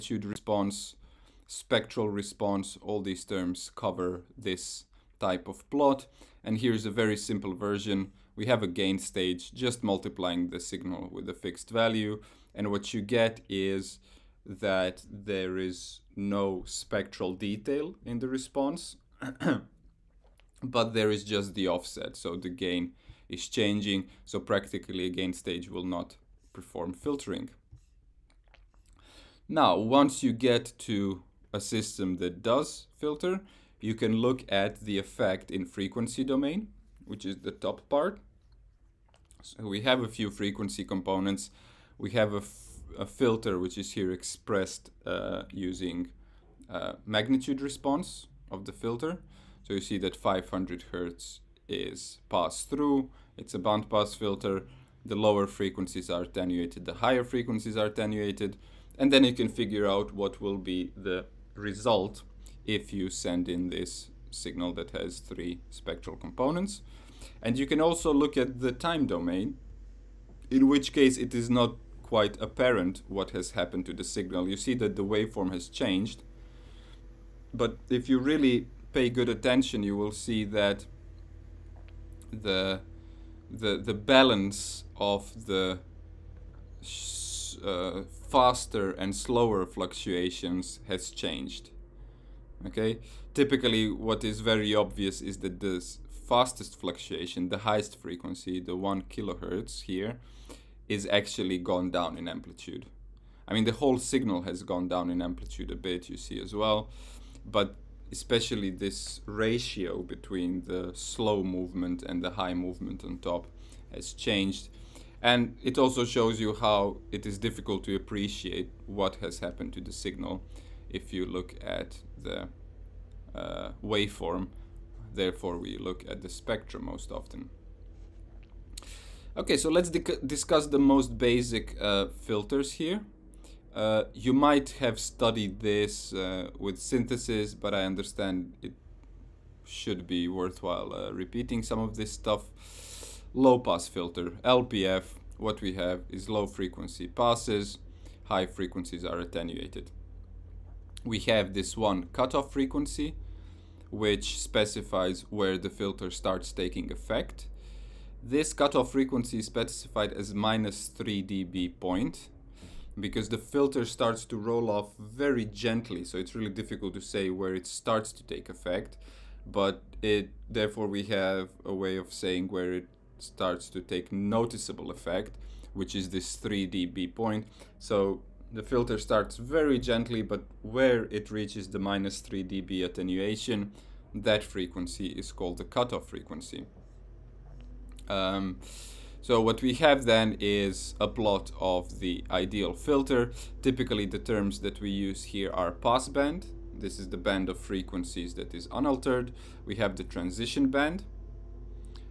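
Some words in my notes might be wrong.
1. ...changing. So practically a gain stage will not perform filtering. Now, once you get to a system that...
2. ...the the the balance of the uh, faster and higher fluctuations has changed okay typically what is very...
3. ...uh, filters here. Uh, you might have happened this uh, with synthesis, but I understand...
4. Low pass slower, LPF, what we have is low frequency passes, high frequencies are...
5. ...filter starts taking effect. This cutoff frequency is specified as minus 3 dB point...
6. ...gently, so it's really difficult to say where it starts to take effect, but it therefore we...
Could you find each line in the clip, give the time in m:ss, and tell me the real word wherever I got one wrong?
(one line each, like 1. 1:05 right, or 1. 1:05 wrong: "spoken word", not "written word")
1. 0:23 right
2. 1:22 wrong: "slower", not "higher"
3. 2:11 wrong: "studied", not "happened"
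4. 2:23 wrong: "filter", not "slower"
5. 2:35 right
6. 2:45 right.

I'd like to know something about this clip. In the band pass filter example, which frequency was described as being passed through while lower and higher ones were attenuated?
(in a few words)
500 Hz.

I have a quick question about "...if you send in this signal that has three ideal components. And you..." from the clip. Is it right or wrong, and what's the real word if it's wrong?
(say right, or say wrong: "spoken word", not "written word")
wrong: "spectral", not "ideal".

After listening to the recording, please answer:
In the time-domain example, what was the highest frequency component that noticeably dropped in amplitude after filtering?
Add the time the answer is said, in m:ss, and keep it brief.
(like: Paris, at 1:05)
1 kHz, at 1:38.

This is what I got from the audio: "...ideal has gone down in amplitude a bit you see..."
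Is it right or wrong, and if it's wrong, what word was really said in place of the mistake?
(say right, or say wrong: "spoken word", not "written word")
wrong: "signal", not "ideal".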